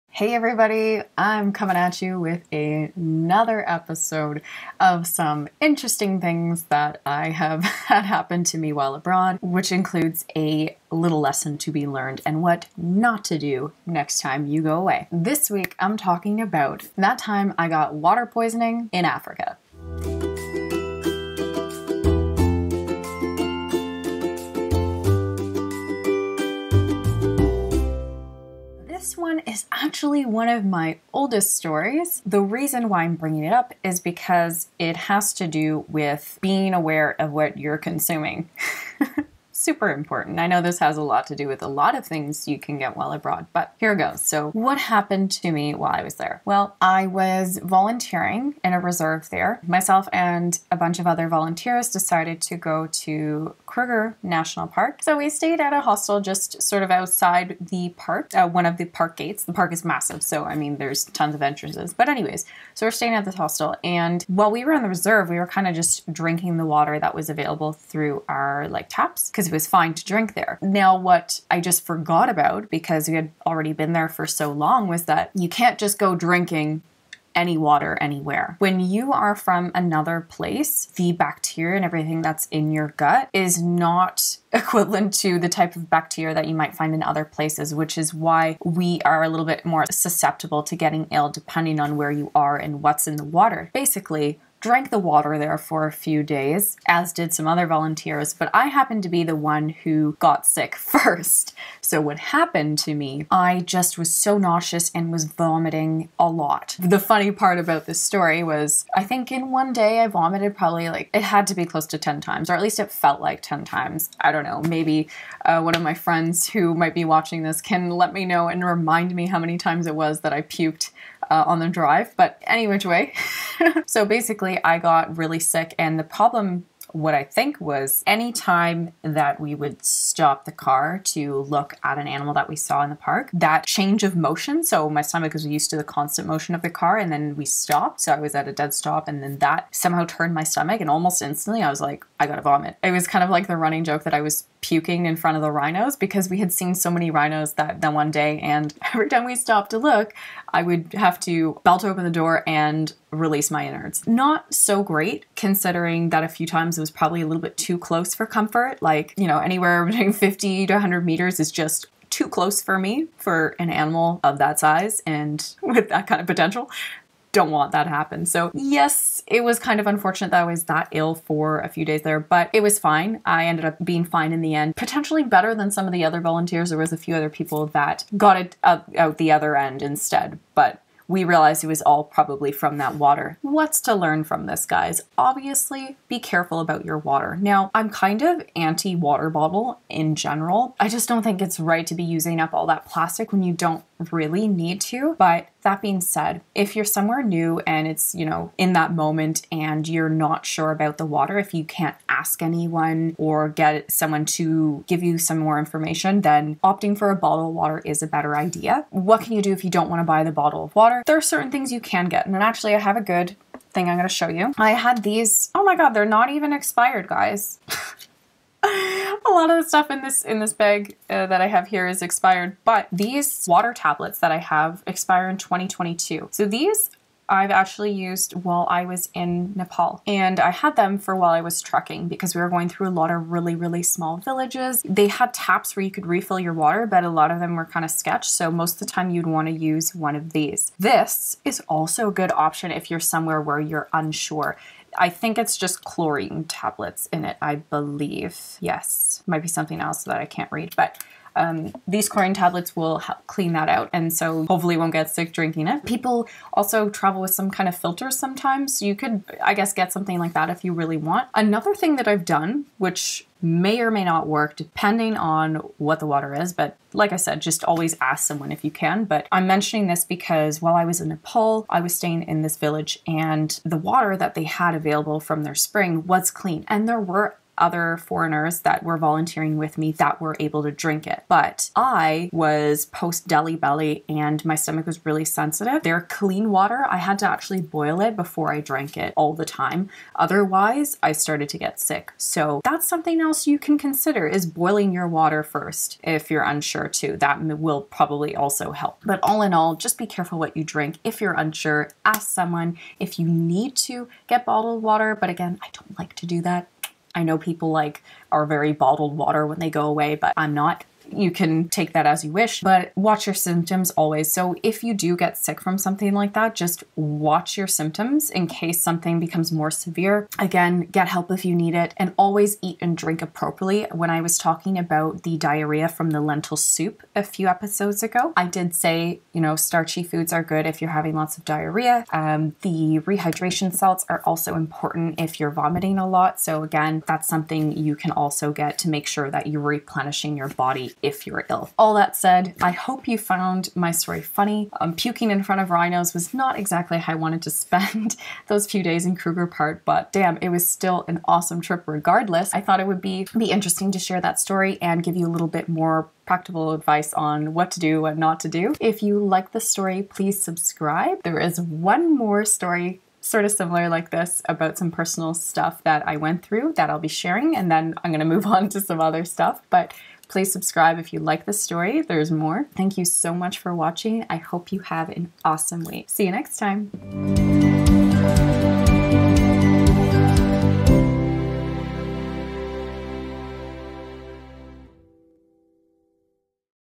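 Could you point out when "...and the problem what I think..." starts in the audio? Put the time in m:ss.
2:05.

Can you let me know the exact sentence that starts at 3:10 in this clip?
I just don't think it's right to be using up all that plastic when you don't really need to.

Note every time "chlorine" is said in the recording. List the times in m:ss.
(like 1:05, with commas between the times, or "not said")
4:05, 4:12.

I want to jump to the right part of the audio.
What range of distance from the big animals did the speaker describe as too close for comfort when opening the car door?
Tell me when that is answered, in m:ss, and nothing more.
2:40.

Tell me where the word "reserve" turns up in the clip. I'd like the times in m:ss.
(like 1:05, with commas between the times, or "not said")
0:48, 1:04.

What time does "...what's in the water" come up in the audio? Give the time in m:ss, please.
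1:32.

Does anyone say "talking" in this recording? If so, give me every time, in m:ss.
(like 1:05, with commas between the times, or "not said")
0:15, 5:24.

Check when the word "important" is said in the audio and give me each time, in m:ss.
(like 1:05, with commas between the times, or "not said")
0:39, 5:34.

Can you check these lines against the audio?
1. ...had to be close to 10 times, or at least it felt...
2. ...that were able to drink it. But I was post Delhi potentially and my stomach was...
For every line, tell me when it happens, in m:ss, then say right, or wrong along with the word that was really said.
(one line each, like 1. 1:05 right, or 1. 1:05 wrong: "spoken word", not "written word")
1. 1:51 right
2. 4:39 wrong: "belly", not "potentially".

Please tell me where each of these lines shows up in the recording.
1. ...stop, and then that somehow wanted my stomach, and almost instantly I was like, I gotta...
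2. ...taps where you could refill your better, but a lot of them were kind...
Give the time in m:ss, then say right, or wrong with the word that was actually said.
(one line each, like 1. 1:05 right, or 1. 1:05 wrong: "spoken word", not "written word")
1. 2:18 wrong: "turned", not "wanted"
2. 3:55 wrong: "water", not "better".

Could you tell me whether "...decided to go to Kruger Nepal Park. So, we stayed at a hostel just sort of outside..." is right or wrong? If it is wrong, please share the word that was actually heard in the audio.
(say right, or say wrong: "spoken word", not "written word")
wrong: "National", not "Nepal".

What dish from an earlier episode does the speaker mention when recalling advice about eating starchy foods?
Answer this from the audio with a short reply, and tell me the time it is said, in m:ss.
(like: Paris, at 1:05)
Lentil soup, at 5:26.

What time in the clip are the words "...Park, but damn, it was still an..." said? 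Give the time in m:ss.
5:49.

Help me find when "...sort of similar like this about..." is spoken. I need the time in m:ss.
6:03.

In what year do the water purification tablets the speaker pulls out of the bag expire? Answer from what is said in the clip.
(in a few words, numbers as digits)
2022.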